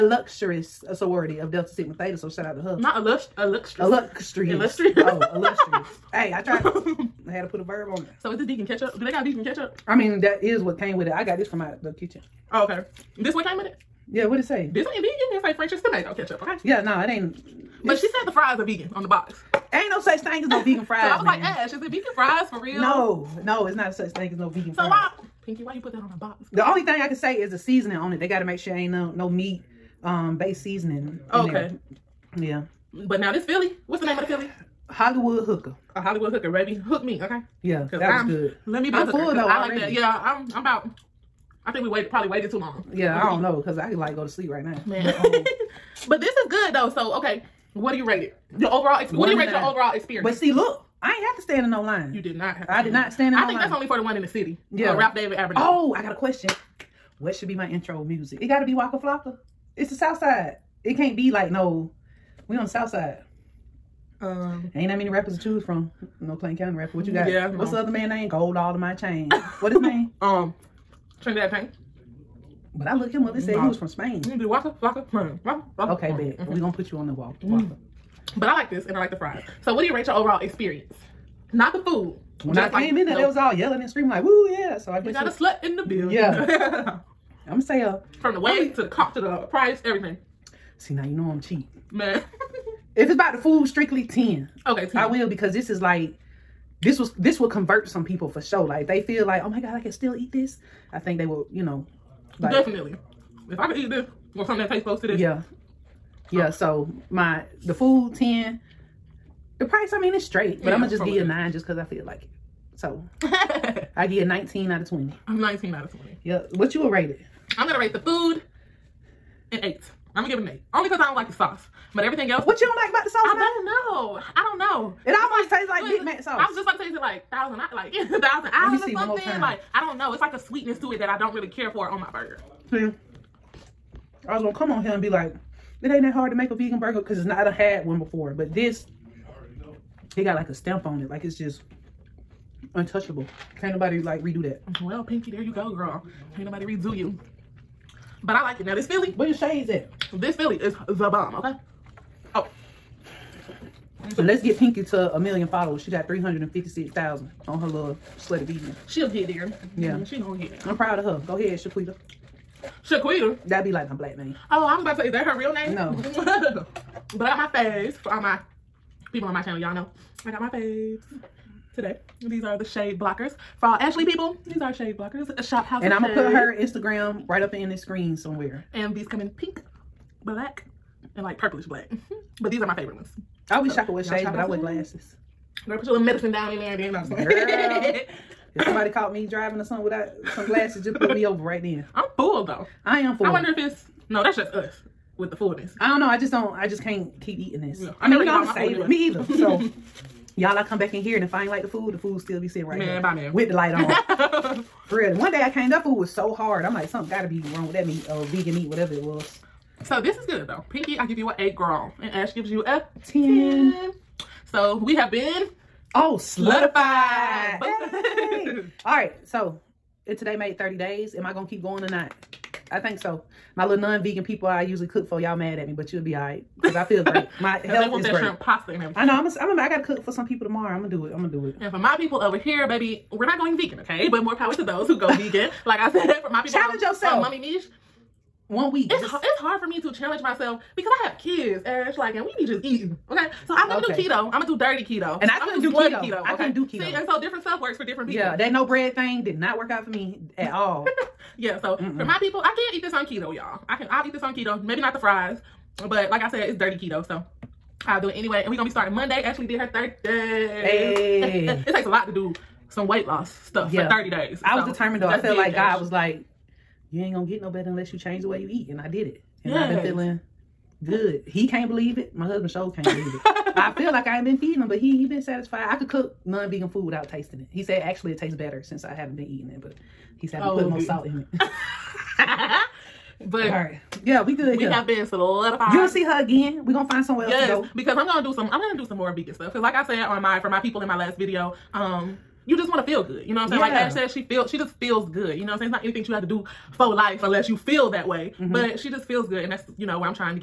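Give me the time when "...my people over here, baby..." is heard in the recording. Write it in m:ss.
3:51.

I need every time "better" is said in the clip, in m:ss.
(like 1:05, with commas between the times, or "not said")
4:27, 4:38.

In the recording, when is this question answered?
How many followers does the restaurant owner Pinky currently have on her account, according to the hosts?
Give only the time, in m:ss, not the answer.
2:36.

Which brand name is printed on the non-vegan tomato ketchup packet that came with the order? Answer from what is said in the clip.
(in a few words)
French's.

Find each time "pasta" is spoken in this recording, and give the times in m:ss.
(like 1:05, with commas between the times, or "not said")
3:48.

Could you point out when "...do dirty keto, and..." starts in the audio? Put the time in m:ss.
4:04.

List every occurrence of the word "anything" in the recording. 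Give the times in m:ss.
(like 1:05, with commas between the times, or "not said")
4:55.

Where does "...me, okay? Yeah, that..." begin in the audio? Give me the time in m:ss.
0:37.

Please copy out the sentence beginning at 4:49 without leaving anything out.
Cause like I said on my for my people in my last video, um you just want to feel good.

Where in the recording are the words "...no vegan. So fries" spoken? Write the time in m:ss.
0:24.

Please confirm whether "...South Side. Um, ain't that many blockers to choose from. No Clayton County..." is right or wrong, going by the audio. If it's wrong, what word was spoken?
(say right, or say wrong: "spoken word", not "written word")
wrong: "rappers", not "blockers".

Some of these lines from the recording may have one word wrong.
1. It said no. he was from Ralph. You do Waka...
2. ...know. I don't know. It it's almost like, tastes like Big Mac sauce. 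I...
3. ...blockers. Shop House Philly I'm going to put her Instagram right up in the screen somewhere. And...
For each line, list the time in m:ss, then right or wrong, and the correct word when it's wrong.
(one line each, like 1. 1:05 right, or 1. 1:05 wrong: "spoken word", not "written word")
1. 1:13 wrong: "Spain", not "Ralph"
2. 2:03 right
3. 2:54 wrong: "And", not "Philly".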